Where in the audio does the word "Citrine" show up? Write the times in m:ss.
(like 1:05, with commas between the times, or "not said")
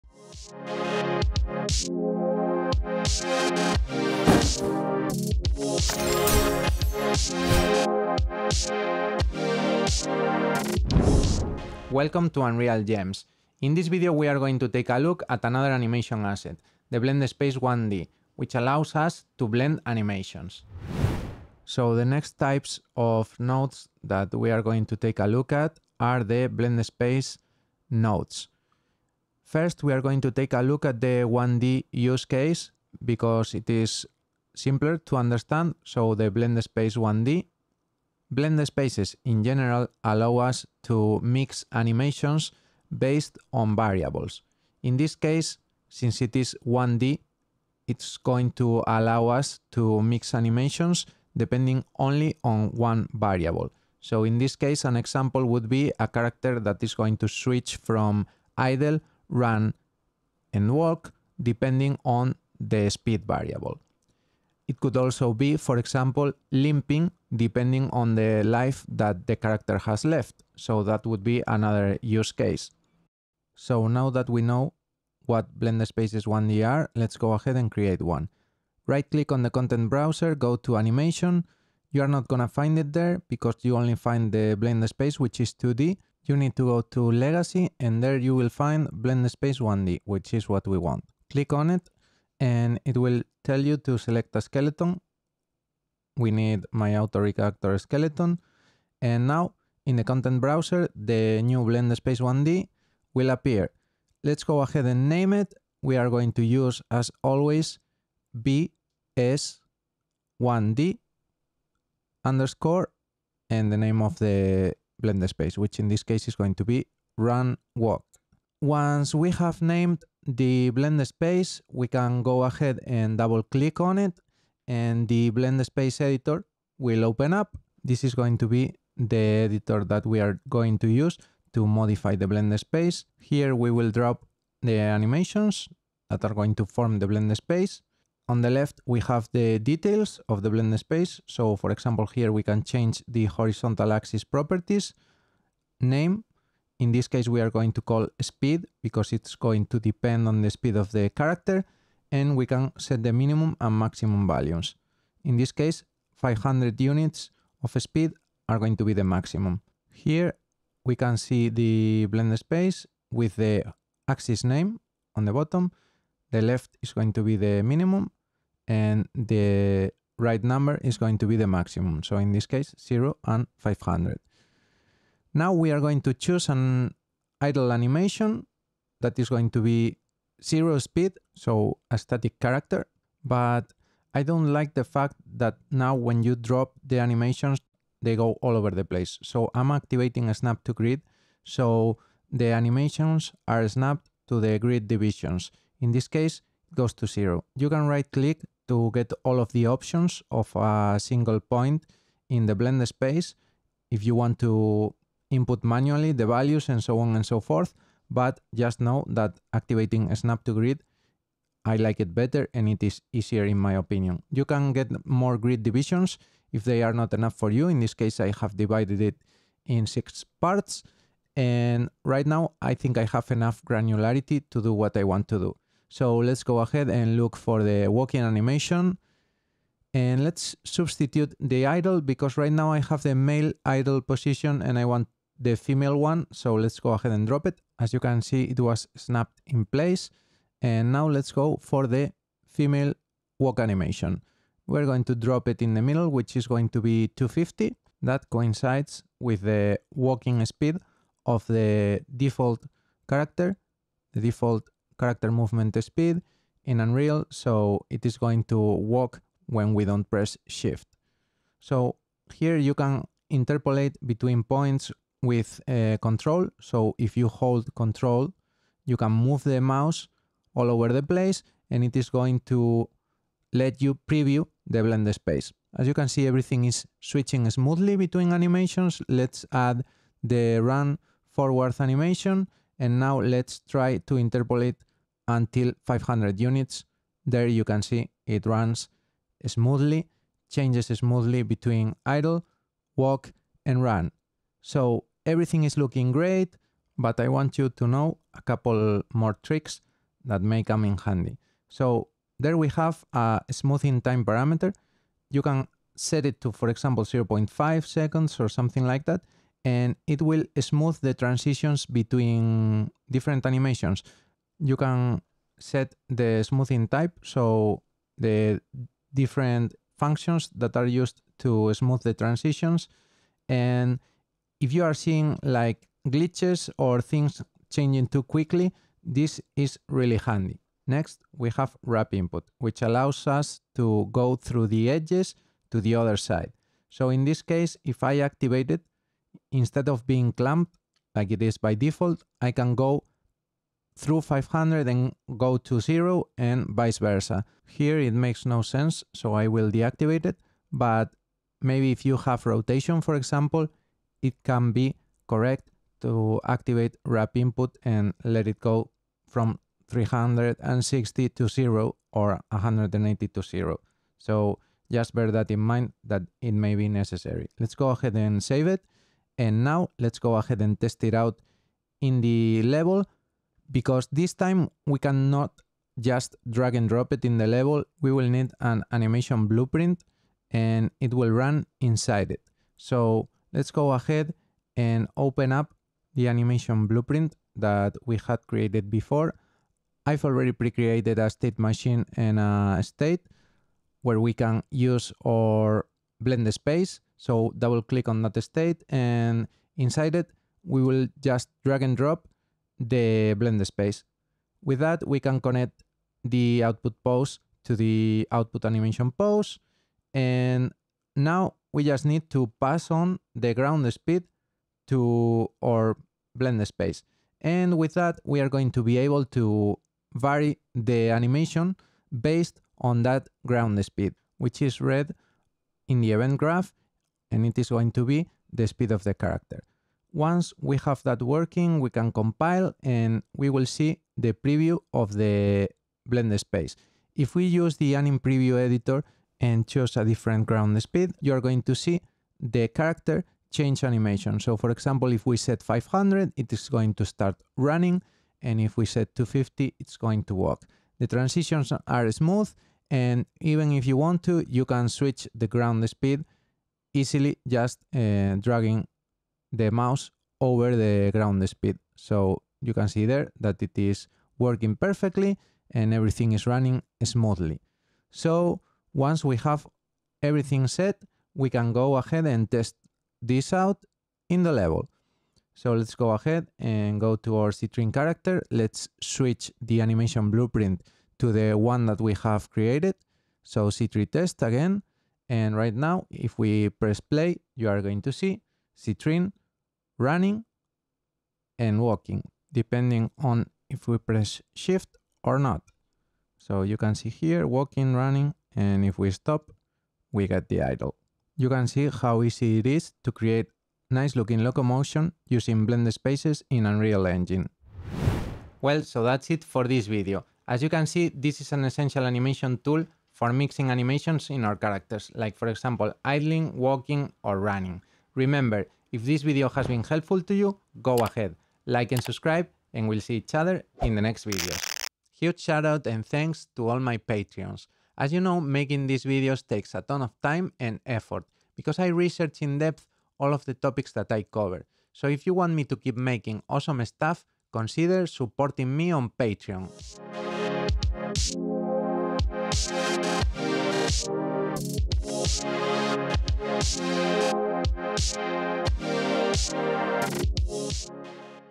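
7:57, 8:03, 8:08.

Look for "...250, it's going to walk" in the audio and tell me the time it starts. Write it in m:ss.
7:29.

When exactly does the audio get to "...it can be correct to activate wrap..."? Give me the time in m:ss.
5:54.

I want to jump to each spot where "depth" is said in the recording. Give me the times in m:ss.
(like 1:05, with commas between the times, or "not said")
8:52.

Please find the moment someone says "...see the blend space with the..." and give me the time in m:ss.
2:41.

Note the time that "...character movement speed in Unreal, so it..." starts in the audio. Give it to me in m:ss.
4:15.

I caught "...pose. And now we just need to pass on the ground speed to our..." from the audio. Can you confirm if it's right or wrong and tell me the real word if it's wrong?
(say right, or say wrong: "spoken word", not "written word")
right.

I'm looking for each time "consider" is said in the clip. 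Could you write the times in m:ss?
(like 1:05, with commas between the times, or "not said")
8:57.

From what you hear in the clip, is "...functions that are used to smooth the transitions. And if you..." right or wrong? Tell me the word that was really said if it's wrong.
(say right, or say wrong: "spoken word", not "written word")
right.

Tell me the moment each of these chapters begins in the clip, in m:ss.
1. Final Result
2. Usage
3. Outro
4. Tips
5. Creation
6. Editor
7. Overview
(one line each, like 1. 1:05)
1. 7:55
2. 6:26
3. 8:27
4. 5:01
5. 1:13
6. 2:07
7. 0:20.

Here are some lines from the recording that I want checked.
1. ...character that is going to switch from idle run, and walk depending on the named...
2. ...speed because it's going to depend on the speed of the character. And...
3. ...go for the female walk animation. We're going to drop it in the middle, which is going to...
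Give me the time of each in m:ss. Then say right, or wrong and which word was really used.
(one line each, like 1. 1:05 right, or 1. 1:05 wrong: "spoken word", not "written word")
1. 0:56 wrong: "speed", not "named"
2. 2:28 right
3. 4:01 right.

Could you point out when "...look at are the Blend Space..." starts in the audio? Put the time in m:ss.
0:25.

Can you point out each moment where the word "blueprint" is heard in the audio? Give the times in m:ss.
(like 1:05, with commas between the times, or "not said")
6:19, 6:26, 8:00.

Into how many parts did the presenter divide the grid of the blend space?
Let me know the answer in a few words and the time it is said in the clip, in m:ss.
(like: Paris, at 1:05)
6, at 3:39.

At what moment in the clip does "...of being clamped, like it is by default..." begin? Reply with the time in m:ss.
5:39.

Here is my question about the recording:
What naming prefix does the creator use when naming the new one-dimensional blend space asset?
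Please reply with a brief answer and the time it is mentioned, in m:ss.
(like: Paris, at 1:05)
BS1D, at 1:48.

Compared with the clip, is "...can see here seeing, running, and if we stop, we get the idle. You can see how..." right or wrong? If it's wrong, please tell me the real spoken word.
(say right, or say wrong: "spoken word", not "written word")
wrong: "walking", not "seeing".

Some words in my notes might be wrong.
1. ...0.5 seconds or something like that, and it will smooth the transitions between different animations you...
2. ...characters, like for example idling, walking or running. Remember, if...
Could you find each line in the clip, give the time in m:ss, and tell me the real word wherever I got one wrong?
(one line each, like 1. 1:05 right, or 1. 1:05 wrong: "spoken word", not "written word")
1. 5:07 right
2. 8:34 right.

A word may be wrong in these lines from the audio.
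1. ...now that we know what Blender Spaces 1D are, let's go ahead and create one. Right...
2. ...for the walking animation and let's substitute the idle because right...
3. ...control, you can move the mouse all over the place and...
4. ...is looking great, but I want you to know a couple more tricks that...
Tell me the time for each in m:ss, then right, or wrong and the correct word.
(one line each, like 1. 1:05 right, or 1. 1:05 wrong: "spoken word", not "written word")
1. 1:13 right
2. 3:47 right
3. 4:27 right
4. 4:55 right.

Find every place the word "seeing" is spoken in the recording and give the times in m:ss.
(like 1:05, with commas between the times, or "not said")
5:24.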